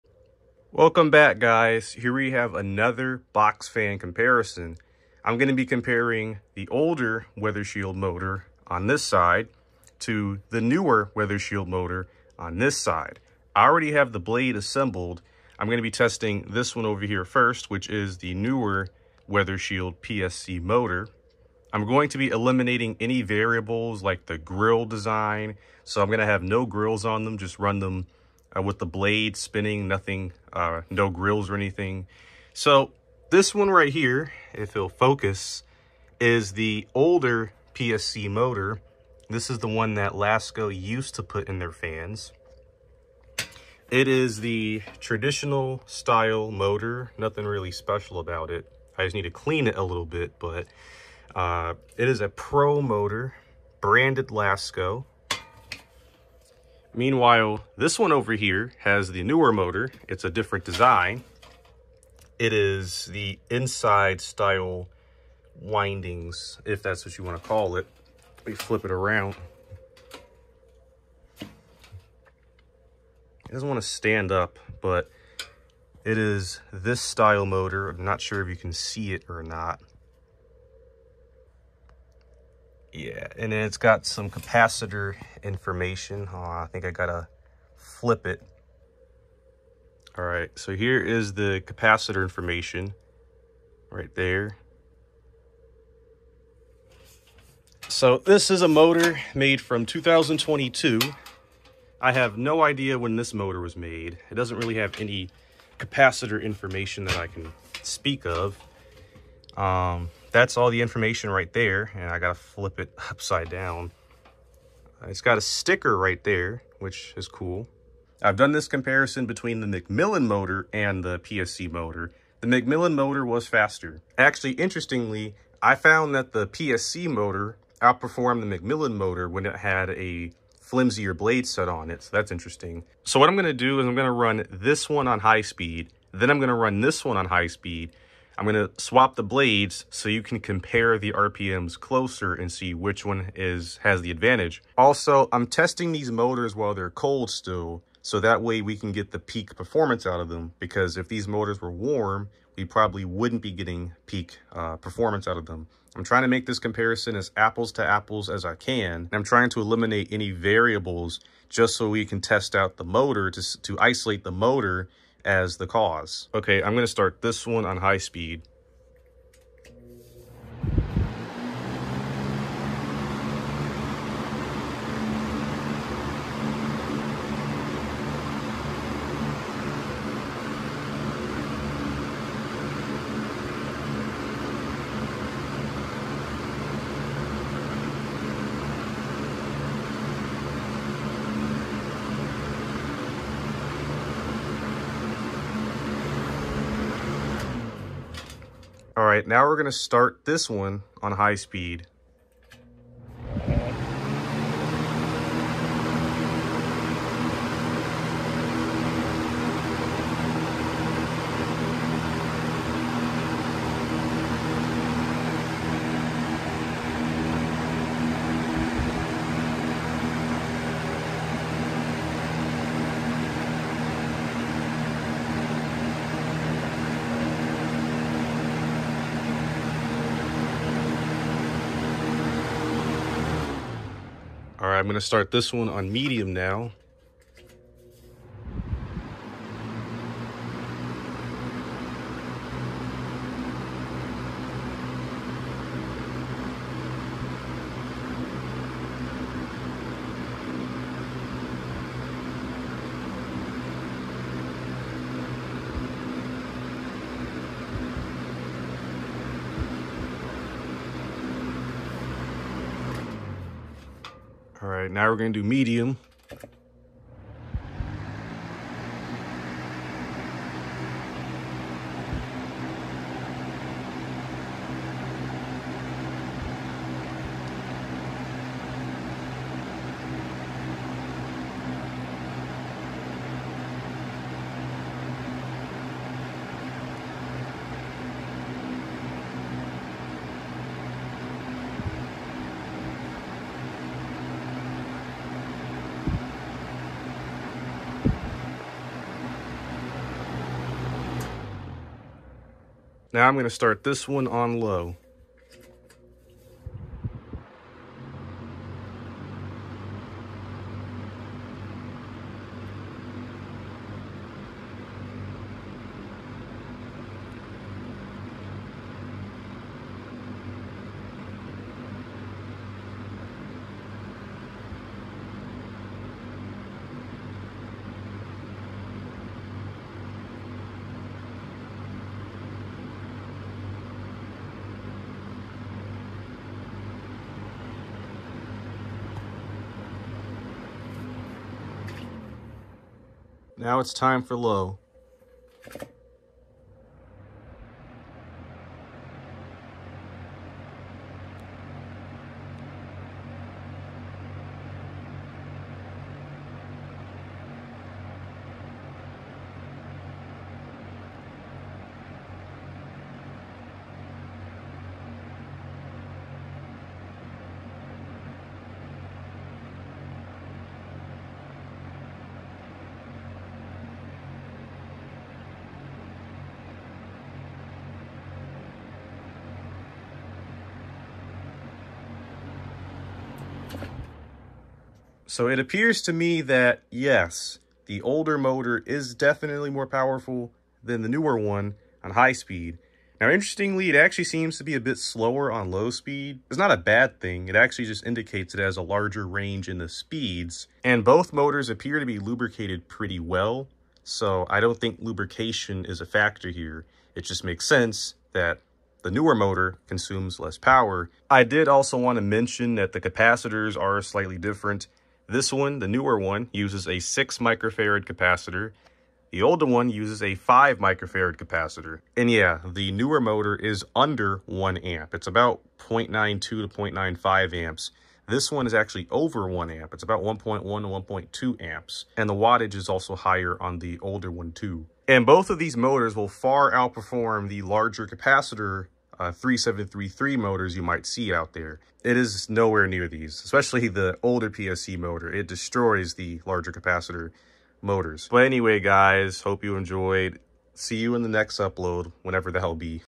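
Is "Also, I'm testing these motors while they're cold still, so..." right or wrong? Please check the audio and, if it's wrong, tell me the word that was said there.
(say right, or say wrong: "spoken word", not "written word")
right.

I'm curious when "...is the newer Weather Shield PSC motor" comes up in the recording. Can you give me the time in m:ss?
0:17.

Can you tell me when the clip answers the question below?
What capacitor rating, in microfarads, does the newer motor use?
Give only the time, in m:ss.
6:56.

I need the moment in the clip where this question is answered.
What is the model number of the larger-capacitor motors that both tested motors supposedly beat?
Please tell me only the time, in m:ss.
7:19.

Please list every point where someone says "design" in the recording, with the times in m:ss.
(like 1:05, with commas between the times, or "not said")
0:24, 1:00.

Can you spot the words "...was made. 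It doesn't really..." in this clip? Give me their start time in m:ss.
1:43.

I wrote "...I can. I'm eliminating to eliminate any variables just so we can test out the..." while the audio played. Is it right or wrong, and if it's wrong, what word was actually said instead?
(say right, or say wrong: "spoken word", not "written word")
wrong: "trying", not "eliminating".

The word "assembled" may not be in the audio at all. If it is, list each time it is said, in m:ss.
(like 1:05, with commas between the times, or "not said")
0:14.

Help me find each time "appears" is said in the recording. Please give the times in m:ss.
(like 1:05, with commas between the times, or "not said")
6:25, 6:41.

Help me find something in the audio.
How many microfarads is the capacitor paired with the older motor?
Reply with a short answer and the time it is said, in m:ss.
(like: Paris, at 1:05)
5 microfarad, at 7:00.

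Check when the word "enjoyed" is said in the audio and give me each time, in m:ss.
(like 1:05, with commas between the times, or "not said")
7:29.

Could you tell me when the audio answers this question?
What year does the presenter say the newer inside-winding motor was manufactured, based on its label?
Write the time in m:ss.
1:39.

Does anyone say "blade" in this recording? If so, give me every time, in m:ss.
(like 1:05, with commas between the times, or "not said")
0:14, 0:28, 2:11, 2:19.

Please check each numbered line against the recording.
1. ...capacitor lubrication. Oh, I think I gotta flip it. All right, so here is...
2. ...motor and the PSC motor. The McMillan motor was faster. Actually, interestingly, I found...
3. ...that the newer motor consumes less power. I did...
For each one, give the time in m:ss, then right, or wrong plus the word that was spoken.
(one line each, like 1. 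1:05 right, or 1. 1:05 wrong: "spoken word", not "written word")
1. 1:24 wrong: "information", not "lubrication"
2. 2:00 right
3. 6:48 right.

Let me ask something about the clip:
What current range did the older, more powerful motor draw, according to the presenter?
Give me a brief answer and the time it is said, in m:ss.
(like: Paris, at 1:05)
1.1 to 1.2 amps, at 7:10.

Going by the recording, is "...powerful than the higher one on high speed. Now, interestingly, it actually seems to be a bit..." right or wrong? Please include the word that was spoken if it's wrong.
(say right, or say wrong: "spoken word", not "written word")
wrong: "newer", not "higher".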